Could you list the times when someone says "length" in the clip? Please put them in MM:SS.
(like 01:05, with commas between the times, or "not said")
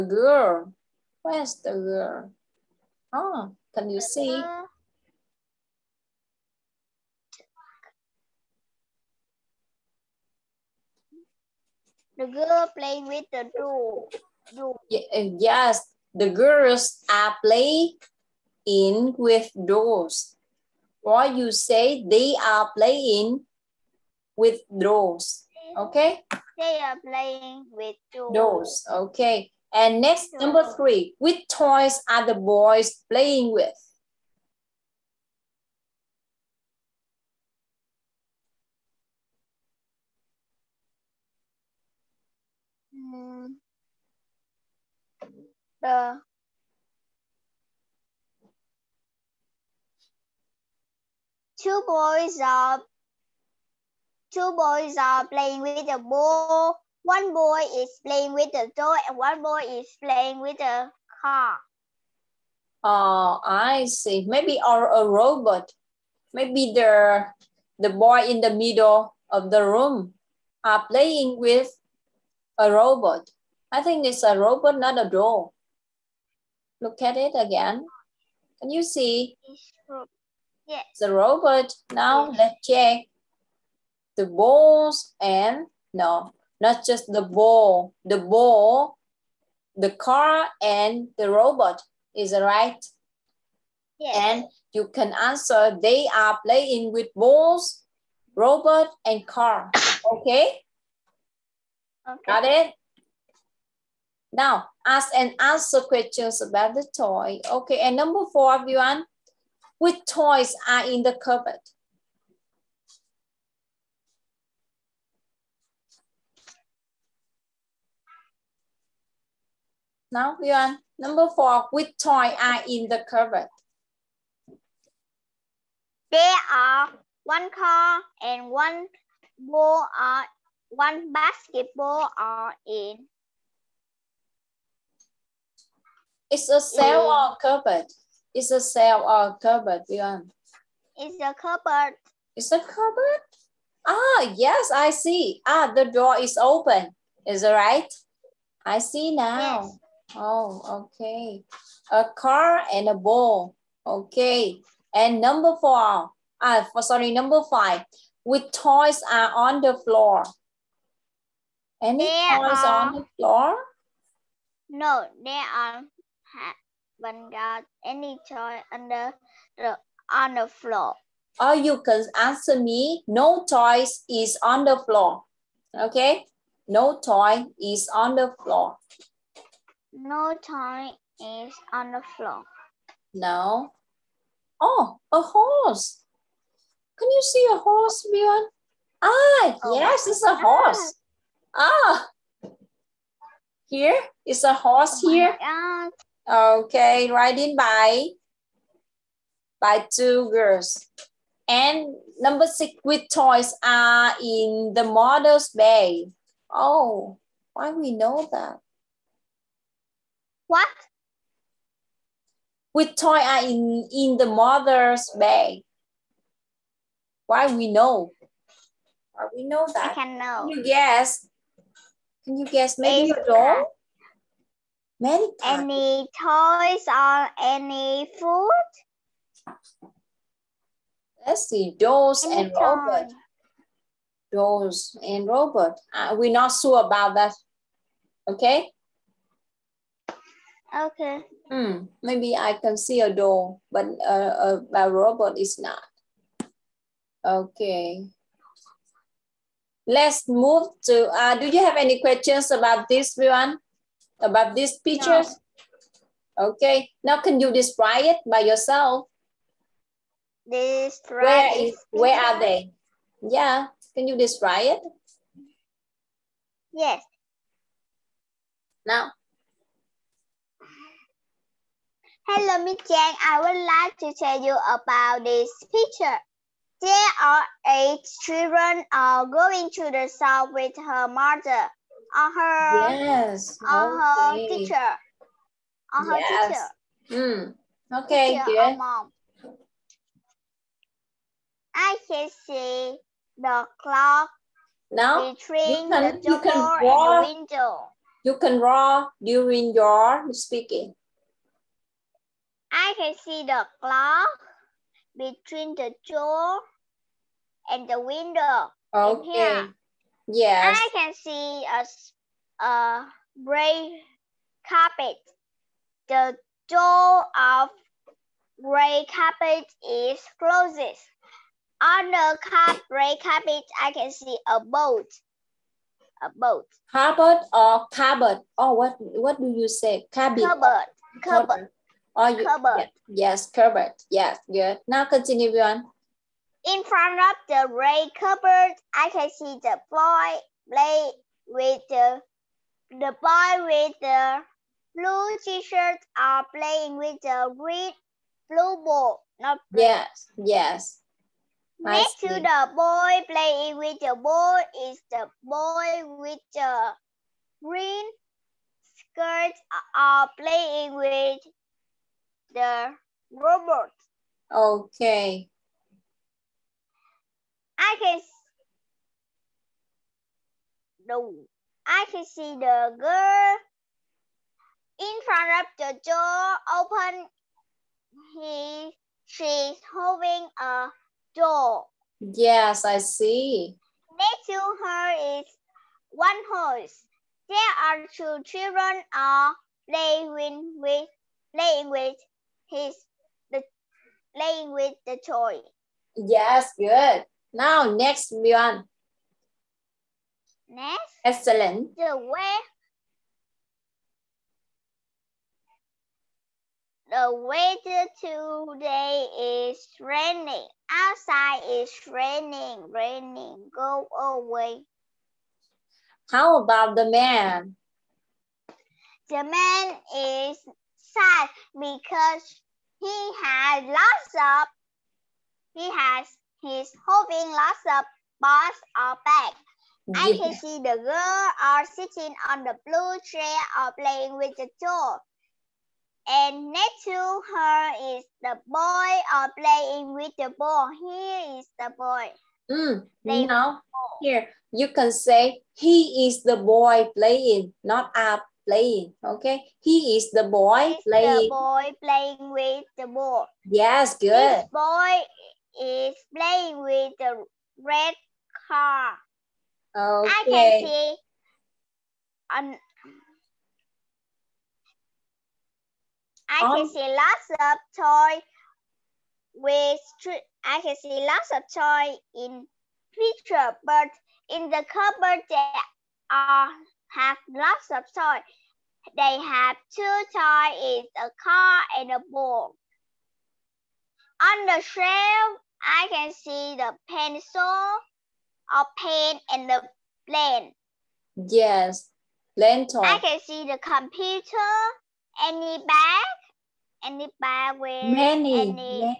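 not said.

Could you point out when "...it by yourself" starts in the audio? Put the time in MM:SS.
04:18.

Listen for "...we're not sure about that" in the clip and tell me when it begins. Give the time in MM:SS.
03:56.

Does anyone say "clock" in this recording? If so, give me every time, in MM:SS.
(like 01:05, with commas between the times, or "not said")
04:53, 05:03.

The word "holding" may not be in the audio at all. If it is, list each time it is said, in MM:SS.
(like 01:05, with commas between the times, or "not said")
06:19, 07:07.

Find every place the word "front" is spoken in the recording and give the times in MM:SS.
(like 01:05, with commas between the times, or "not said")
05:36, 06:15.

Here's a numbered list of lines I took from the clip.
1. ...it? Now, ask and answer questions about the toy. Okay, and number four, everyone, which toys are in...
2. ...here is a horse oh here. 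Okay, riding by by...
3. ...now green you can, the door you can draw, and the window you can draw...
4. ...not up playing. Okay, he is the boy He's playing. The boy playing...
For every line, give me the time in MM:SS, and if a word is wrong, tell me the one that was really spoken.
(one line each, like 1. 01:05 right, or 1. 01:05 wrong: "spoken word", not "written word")
1. 01:42 right
2. 03:13 right
3. 04:54 wrong: "between", not "green"
4. 07:27 right.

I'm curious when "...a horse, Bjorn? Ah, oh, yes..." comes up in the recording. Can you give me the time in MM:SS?
03:07.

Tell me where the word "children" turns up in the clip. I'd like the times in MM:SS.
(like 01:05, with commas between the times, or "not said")
04:38, 06:28.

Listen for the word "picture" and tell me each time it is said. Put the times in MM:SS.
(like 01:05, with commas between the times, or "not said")
04:14, 04:35, 07:53.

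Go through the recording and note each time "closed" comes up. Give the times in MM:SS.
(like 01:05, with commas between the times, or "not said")
05:20.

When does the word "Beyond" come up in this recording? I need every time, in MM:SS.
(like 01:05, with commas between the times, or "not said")
02:19.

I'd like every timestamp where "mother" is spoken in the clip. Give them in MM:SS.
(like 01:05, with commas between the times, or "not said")
03:34, 04:41.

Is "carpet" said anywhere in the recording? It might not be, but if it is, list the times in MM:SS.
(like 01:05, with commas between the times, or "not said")
05:14, 05:19, 05:23.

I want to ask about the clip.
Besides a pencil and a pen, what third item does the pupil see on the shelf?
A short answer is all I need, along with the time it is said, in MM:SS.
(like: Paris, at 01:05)
plane, at 08:09.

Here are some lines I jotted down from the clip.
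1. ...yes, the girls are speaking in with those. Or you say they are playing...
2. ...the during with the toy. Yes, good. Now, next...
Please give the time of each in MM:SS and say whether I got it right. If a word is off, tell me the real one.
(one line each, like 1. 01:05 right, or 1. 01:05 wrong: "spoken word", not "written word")
1. 00:15 wrong: "playing", not "speaking"
2. 06:33 wrong: "playing", not "during".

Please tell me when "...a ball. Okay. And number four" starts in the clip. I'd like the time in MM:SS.
02:32.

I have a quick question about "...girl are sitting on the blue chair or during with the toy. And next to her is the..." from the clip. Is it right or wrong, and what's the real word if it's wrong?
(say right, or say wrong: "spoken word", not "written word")
wrong: "playing", not "during".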